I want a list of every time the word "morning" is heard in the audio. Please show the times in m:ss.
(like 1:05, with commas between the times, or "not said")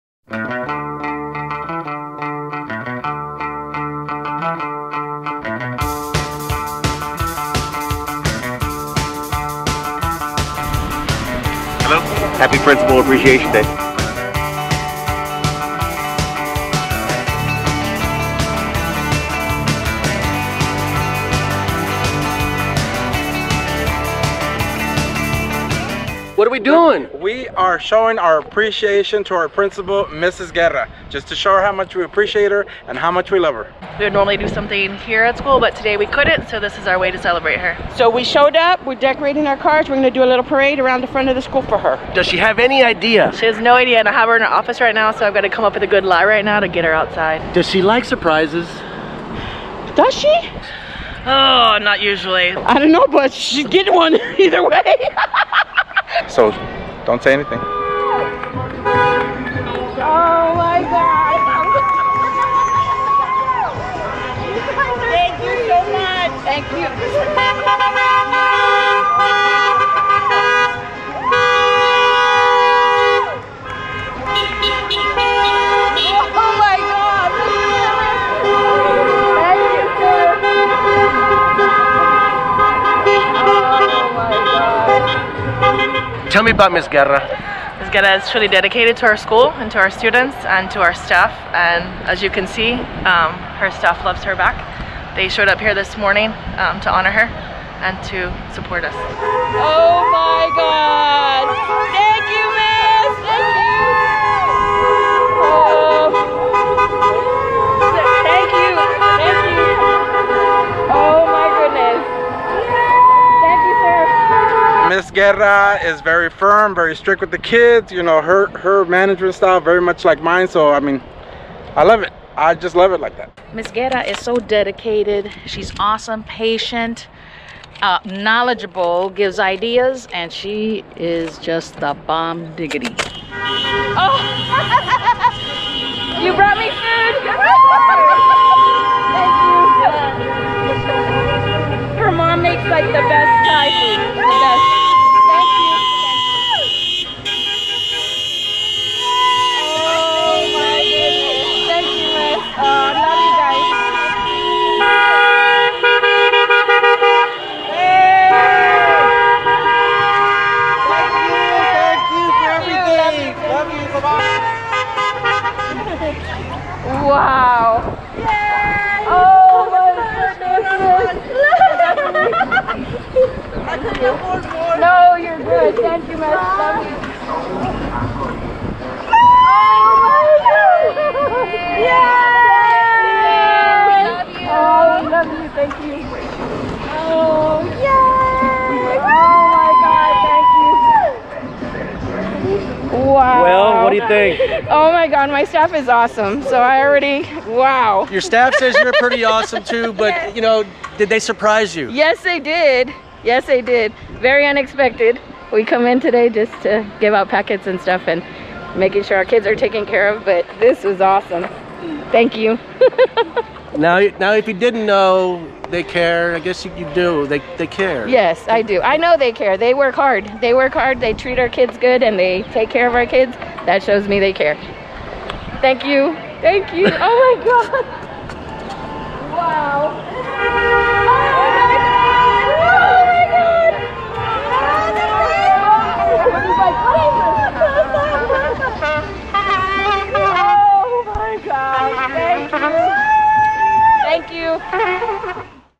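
1:35.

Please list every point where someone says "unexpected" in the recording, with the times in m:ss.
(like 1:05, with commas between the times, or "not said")
3:24.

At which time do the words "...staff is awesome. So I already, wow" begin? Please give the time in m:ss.
3:15.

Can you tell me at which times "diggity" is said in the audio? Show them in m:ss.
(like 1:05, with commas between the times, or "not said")
2:12.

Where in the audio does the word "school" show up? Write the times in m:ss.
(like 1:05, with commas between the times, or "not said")
0:35, 0:41, 1:29.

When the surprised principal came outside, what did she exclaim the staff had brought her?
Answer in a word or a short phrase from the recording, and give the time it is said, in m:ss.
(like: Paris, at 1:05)
food, at 2:18.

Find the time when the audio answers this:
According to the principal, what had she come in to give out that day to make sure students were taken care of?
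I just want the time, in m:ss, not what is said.
3:27.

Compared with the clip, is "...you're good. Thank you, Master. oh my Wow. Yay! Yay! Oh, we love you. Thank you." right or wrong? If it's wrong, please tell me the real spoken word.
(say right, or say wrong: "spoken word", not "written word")
wrong: "God", not "Wow".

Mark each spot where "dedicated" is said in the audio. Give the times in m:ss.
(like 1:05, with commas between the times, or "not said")
1:28, 2:04.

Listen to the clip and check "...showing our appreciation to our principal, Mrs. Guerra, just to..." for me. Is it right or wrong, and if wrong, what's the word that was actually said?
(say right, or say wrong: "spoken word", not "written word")
right.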